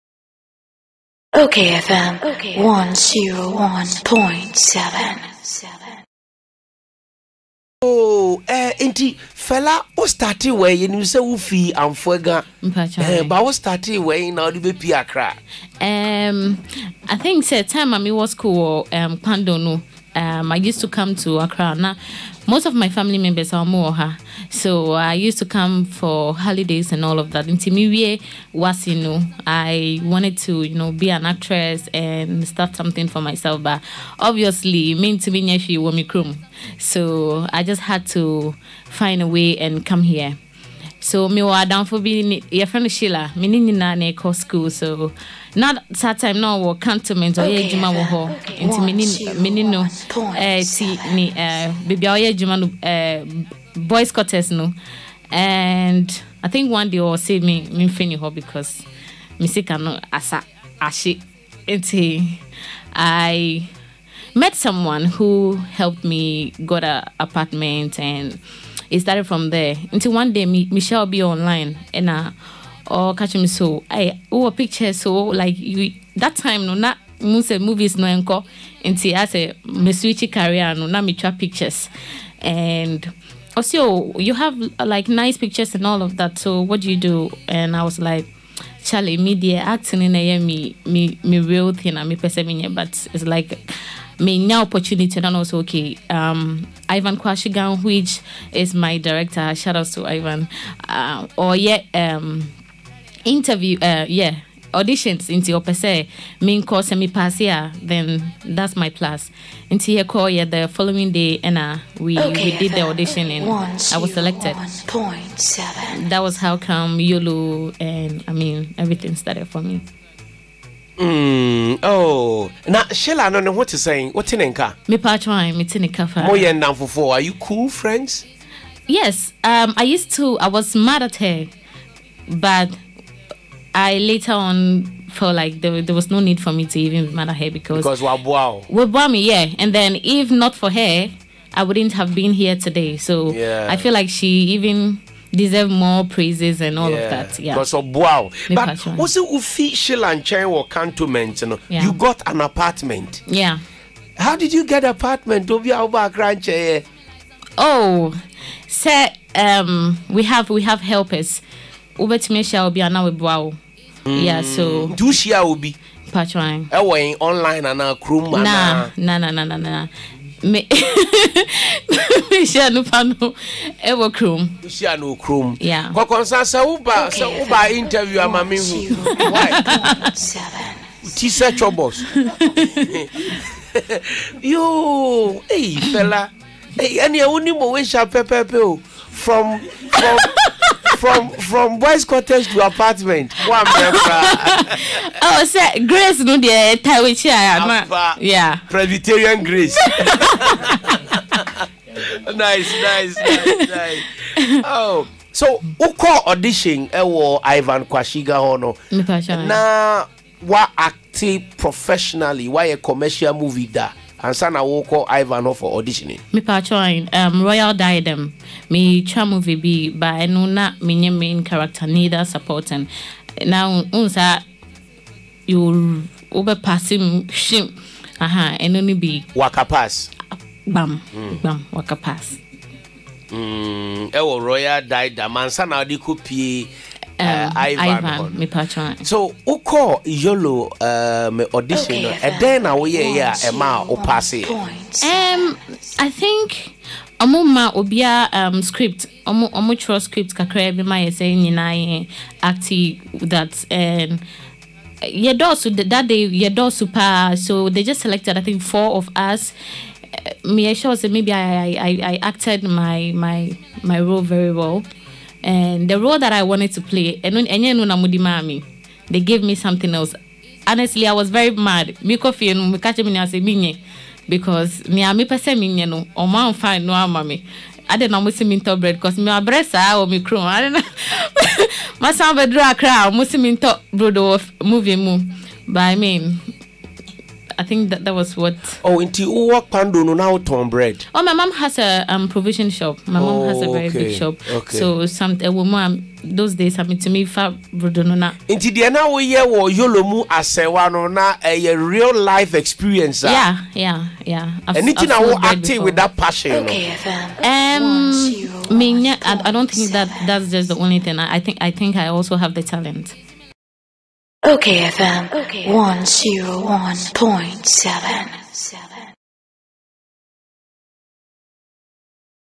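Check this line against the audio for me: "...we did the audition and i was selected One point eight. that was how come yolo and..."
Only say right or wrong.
wrong.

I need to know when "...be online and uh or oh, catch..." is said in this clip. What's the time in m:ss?
1:11.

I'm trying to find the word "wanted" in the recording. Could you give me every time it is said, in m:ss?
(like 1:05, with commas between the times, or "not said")
0:30, 4:26.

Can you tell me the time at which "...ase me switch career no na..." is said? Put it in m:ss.
1:19.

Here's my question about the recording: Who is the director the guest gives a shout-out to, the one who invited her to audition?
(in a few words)
Ivan Quashigah.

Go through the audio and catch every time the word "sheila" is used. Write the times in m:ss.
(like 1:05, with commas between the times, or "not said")
2:02, 2:29.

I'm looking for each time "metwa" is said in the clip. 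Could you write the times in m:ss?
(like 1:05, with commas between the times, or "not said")
3:38.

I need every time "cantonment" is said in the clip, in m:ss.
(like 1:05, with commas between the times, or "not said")
0:46, 2:30.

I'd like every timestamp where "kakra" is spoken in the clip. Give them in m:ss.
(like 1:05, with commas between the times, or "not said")
4:10.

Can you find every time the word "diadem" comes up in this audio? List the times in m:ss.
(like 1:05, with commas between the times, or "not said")
3:37, 3:54.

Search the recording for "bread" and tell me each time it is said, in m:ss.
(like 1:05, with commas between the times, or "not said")
4:38, 4:43, 4:50.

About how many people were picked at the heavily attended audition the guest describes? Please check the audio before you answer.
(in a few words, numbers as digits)
4.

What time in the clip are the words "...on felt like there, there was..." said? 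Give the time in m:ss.
2:14.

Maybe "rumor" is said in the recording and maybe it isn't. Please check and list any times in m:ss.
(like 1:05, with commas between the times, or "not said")
not said.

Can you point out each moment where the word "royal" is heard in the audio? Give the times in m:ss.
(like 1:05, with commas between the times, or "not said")
3:37, 3:54.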